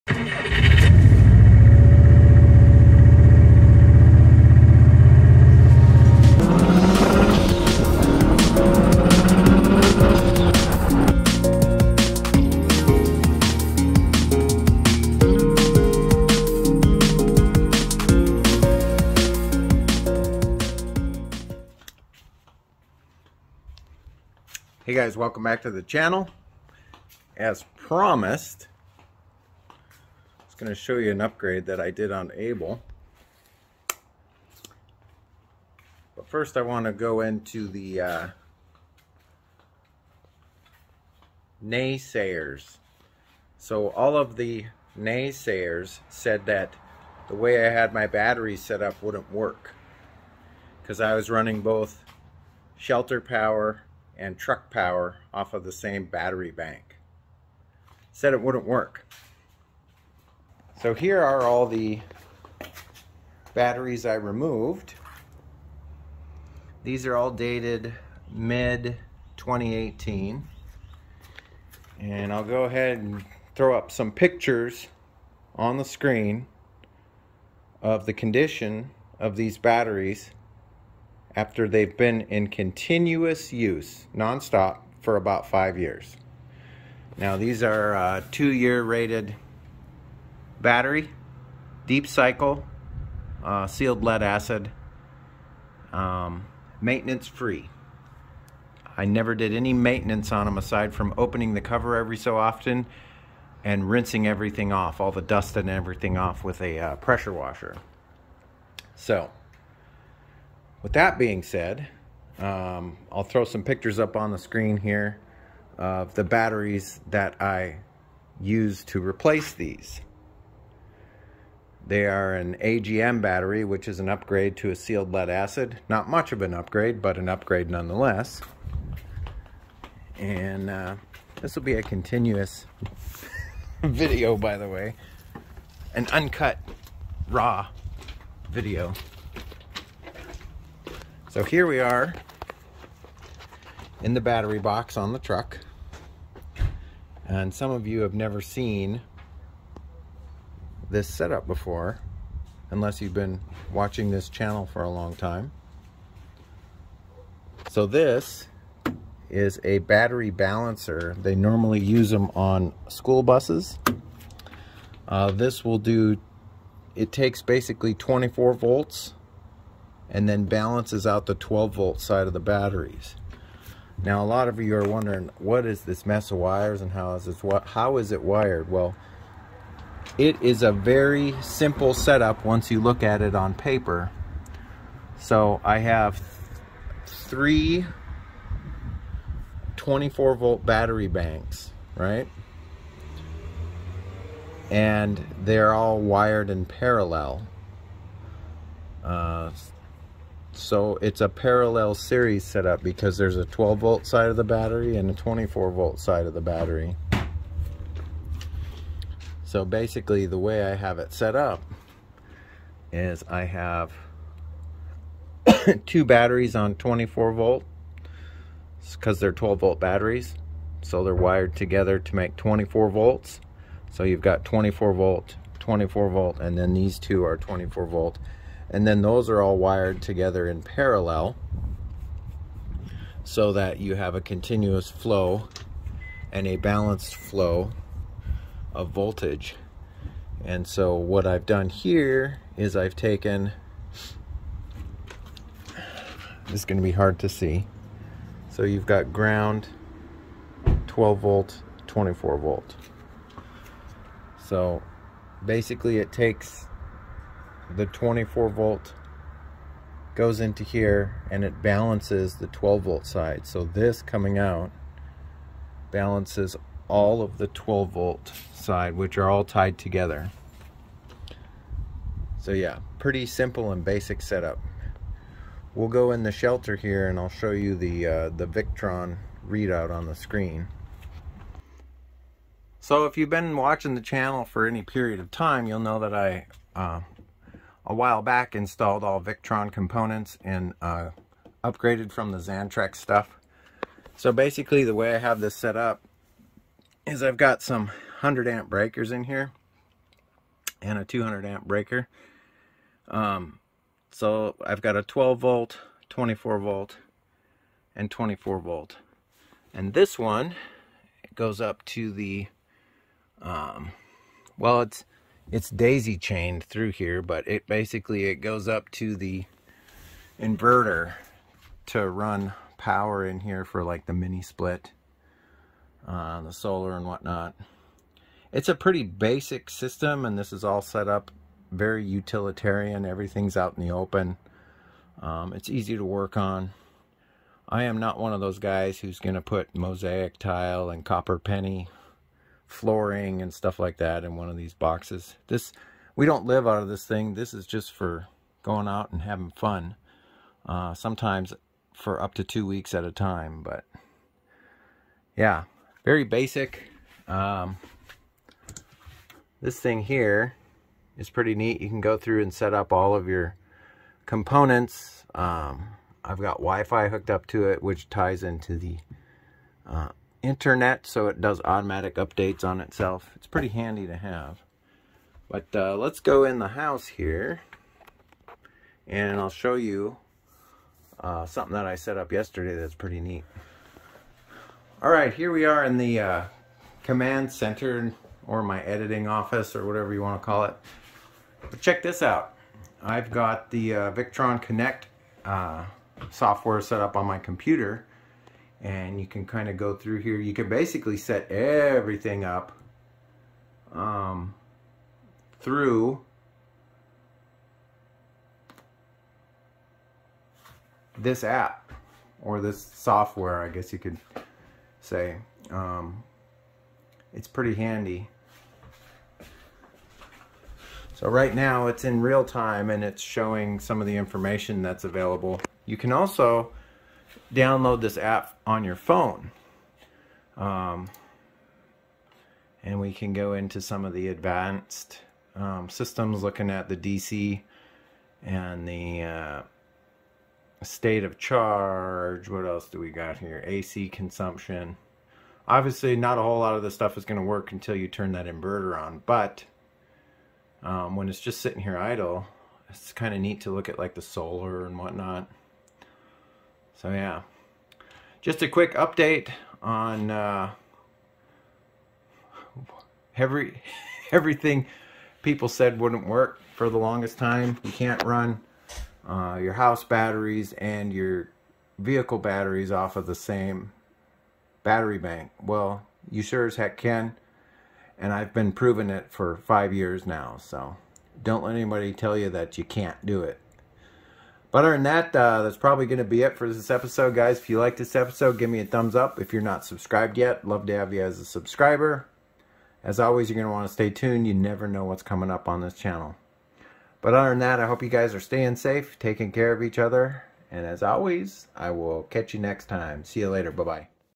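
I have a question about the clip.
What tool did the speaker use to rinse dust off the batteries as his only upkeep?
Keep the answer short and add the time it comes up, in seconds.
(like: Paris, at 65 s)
pressure washer, at 106 s.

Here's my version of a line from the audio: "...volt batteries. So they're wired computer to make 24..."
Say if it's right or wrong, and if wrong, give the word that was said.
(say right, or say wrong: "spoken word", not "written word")
wrong: "together", not "computer".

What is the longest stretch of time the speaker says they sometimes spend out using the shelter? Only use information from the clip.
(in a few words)
two weeks.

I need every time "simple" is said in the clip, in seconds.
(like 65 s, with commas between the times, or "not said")
181 s, 273 s.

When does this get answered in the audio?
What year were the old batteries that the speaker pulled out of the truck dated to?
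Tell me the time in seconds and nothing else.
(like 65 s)
68 s.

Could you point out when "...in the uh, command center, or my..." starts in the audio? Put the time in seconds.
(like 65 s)
385 s.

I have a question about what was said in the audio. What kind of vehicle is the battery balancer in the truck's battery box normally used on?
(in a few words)
school buses.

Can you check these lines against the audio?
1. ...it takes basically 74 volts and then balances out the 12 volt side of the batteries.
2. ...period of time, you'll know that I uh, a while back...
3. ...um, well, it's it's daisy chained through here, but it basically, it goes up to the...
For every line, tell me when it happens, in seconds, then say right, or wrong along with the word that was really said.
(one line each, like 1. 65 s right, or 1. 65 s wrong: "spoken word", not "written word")
1. 166 s wrong: "24", not "74"
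2. 284 s right
3. 313 s right.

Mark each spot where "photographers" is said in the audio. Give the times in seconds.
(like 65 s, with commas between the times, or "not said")
not said.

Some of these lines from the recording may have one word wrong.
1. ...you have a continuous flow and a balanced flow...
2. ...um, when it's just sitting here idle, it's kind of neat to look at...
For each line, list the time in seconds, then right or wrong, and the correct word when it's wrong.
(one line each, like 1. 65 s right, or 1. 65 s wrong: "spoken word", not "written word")
1. 233 s right
2. 450 s right.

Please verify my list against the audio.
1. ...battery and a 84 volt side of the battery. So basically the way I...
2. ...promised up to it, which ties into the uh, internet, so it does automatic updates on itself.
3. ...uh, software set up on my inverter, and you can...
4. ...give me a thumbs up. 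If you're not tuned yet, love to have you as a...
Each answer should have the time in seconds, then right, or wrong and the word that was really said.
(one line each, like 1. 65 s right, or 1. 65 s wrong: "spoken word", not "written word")
1. 204 s wrong: "24", not "84"
2. 367 s wrong: "hooked", not "promised"
3. 395 s wrong: "computer", not "inverter"
4. 488 s wrong: "subscribed", not "tuned".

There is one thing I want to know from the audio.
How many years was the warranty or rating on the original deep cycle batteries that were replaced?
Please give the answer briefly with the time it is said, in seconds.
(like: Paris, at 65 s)
2 years, at 88 s.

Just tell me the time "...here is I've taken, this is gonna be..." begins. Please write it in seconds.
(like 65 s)
241 s.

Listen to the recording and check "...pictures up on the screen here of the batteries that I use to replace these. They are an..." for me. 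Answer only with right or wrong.
right.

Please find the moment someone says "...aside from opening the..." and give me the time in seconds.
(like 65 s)
100 s.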